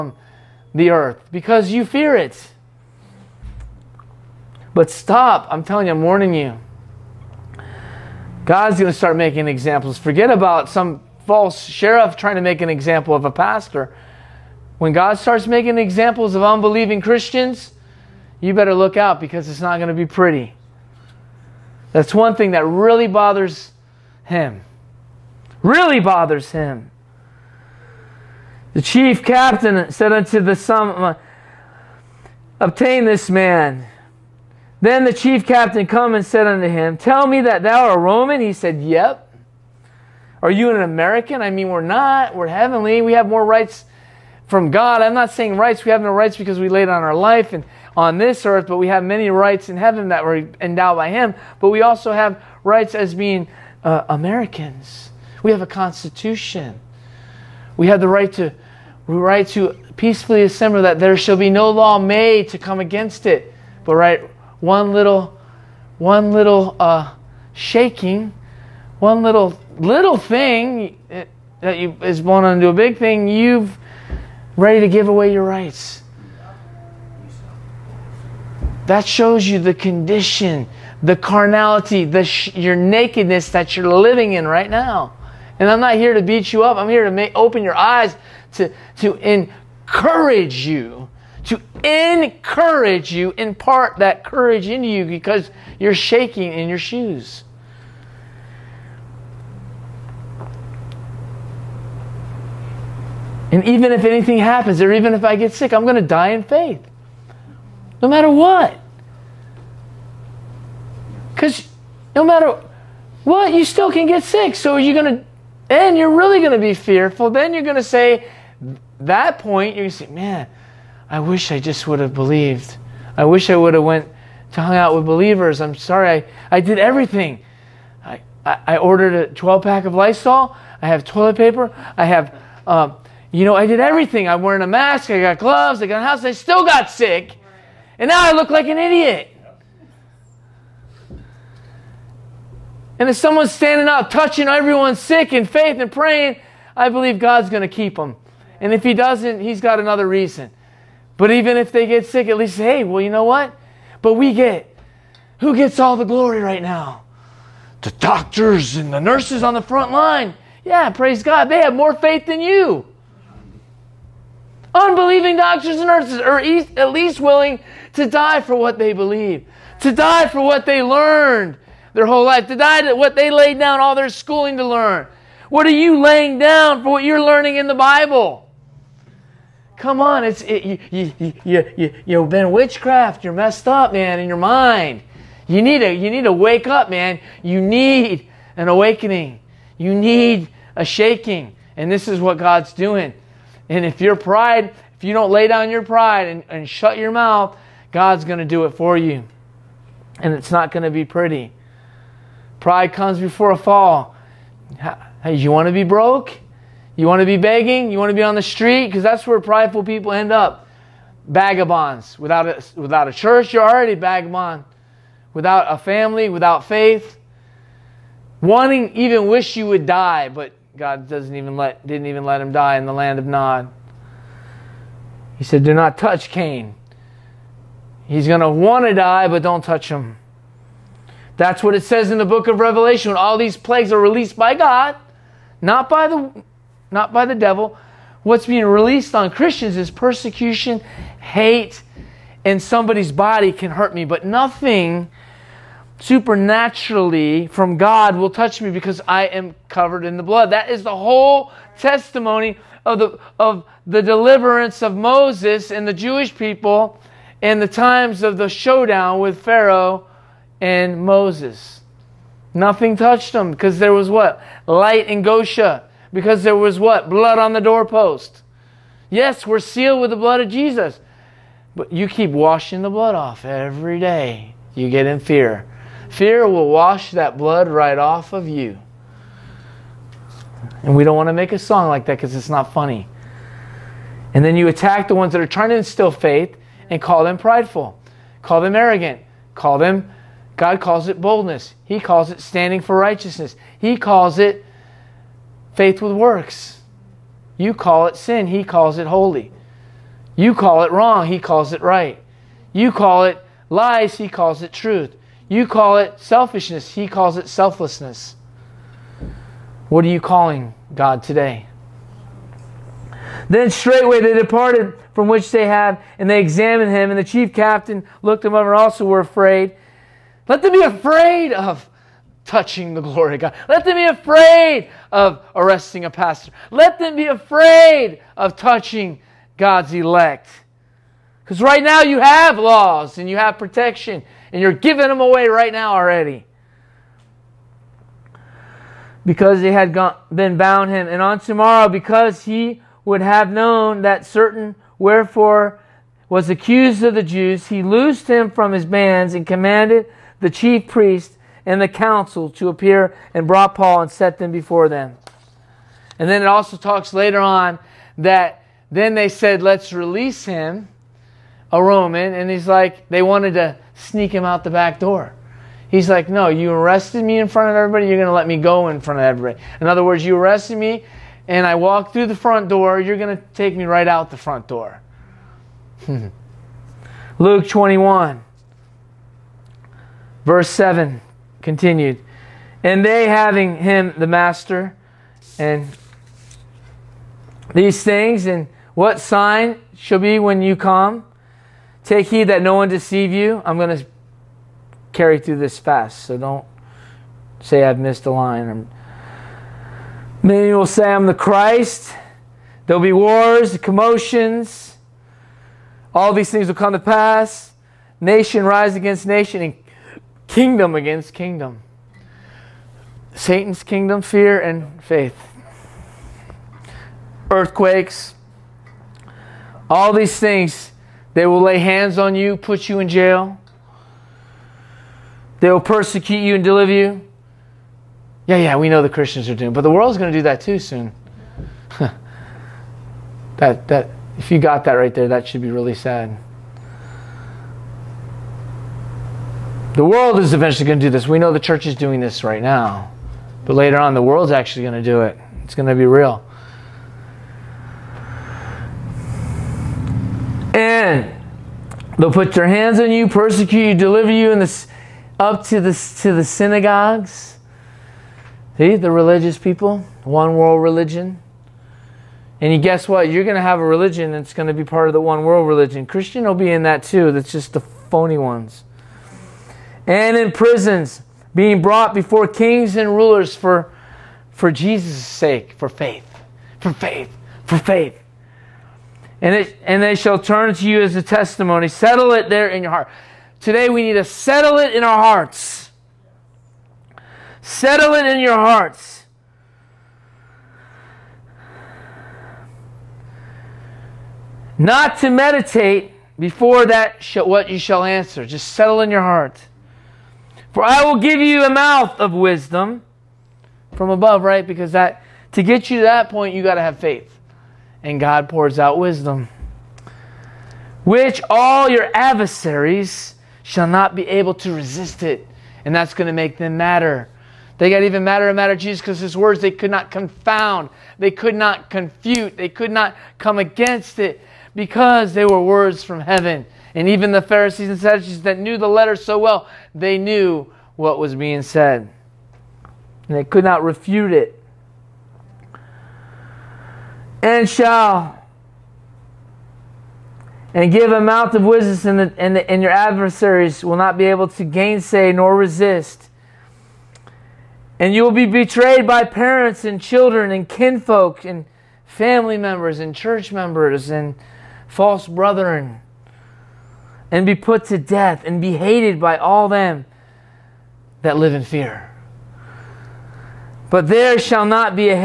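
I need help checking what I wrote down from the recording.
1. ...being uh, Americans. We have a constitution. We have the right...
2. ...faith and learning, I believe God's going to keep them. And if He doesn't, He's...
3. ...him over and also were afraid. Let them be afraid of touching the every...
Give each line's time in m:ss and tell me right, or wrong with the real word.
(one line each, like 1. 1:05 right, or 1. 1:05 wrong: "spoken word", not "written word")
1. 0:53 right
2. 2:25 wrong: "praying", not "learning"
3. 5:18 wrong: "glory", not "every".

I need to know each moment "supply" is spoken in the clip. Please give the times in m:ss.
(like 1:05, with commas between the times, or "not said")
not said.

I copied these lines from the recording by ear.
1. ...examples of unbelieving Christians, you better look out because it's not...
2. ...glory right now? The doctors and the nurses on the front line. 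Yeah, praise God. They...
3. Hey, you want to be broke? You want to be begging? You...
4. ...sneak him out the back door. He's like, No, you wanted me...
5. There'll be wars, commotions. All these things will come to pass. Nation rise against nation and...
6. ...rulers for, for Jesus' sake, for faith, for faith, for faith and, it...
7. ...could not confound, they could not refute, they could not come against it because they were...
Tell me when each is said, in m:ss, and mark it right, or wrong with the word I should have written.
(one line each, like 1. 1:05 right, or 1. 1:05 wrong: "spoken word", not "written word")
1. 0:15 right
2. 2:36 right
3. 3:25 right
4. 6:03 wrong: "arrested", not "wanted"
5. 6:42 right
6. 7:53 right
7. 8:39 wrong: "confute", not "refute".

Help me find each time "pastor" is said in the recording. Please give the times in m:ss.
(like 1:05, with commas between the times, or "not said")
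0:13, 5:26.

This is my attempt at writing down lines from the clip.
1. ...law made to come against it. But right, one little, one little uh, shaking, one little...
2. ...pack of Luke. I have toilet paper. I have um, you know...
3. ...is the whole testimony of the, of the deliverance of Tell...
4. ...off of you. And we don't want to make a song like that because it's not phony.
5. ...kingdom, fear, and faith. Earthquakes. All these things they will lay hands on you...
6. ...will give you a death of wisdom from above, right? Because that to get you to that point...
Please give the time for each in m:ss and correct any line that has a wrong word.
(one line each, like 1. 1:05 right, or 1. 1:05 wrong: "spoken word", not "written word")
1. 1:01 right
2. 2:09 wrong: "Lysol", not "Luke"
3. 4:10 wrong: "Moses", not "Tell"
4. 4:37 wrong: "funny", not "phony"
5. 6:53 right
6. 8:21 wrong: "mouth", not "death".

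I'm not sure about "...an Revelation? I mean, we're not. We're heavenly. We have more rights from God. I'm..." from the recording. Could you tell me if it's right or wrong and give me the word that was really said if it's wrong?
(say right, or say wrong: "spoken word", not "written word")
wrong: "American", not "Revelation".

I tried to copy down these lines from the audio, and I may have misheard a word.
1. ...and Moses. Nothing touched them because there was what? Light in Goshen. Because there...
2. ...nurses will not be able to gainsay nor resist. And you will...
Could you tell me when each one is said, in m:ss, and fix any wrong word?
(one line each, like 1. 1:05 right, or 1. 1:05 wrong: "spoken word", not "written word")
1. 4:20 right
2. 9:02 wrong: "adversaries", not "nurses".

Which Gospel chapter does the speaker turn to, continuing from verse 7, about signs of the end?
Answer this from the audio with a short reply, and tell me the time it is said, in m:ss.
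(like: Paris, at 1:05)
Luke 21, at 6:17.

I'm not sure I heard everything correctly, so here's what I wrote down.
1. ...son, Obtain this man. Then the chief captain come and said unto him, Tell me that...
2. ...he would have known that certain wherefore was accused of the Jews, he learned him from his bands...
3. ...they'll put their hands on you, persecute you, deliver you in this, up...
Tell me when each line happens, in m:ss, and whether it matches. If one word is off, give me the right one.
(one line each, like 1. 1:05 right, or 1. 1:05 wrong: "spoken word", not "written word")
1. 0:30 right
2. 5:42 wrong: "loosed", not "learned"
3. 7:32 right.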